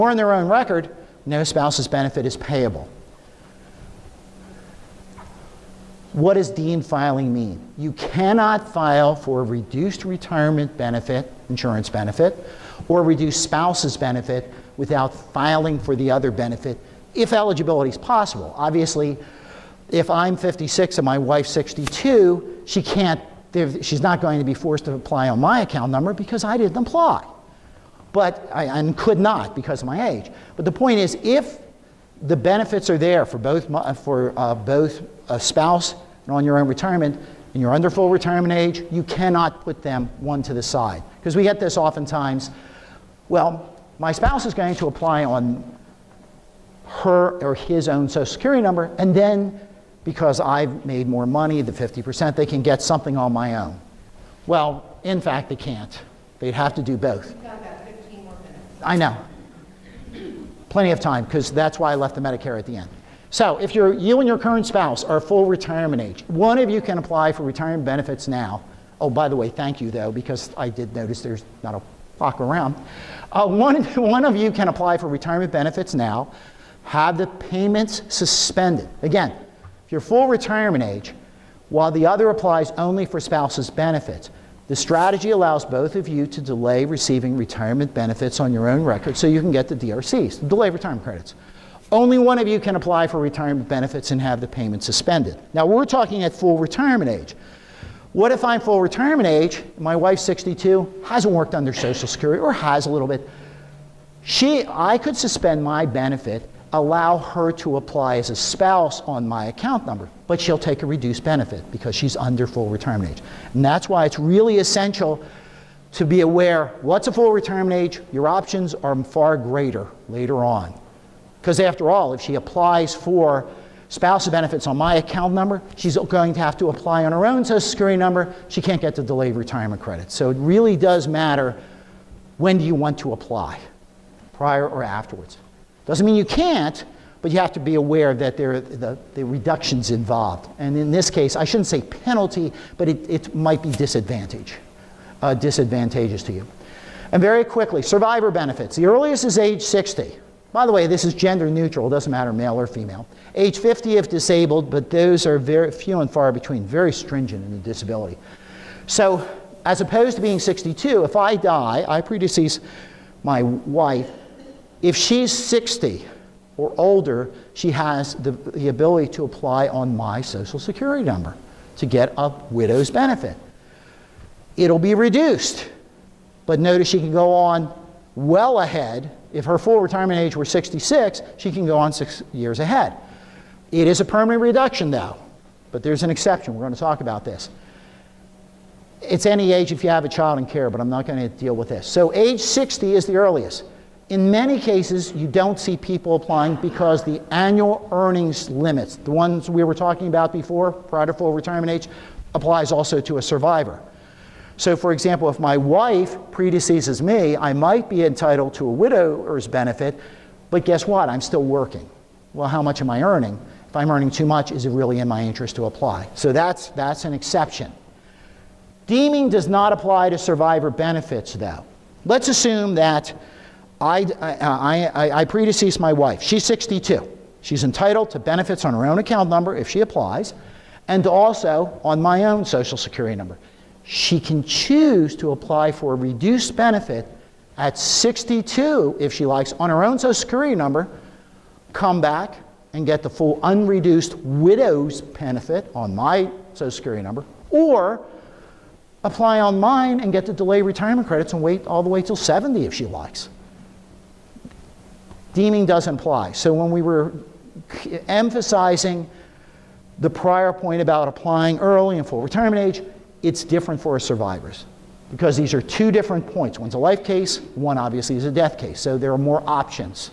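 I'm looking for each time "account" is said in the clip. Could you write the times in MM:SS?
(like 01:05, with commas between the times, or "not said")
00:25, 01:49, 02:04, 03:48.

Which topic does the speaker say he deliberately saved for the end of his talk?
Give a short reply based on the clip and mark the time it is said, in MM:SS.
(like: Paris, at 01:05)
Medicare, at 01:02.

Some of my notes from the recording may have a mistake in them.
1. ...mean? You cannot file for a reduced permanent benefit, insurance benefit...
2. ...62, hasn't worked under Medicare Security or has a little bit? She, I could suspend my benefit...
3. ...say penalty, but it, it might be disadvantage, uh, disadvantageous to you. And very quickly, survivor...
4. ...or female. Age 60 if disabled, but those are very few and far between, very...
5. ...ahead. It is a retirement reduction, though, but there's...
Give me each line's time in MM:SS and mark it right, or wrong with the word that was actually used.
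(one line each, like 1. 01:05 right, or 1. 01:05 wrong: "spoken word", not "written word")
1. 00:07 wrong: "retirement", not "permanent"
2. 01:40 wrong: "Social", not "Medicare"
3. 02:21 right
4. 02:32 wrong: "50", not "60"
5. 03:02 wrong: "permanent", not "retirement".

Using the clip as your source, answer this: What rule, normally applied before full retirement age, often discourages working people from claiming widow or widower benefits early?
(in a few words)
annual earnings limits.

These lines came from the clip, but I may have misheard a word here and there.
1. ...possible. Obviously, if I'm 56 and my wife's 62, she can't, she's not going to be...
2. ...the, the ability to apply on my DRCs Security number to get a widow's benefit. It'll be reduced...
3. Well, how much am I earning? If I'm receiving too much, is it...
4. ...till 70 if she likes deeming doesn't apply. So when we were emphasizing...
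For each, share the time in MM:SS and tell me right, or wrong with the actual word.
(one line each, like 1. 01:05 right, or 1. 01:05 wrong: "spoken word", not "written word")
1. 00:17 right
2. 02:48 wrong: "Social", not "DRCs"
3. 03:32 wrong: "earning", not "receiving"
4. 04:12 right.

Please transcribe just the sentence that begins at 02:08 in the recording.
She can't get the delayed retirement credit.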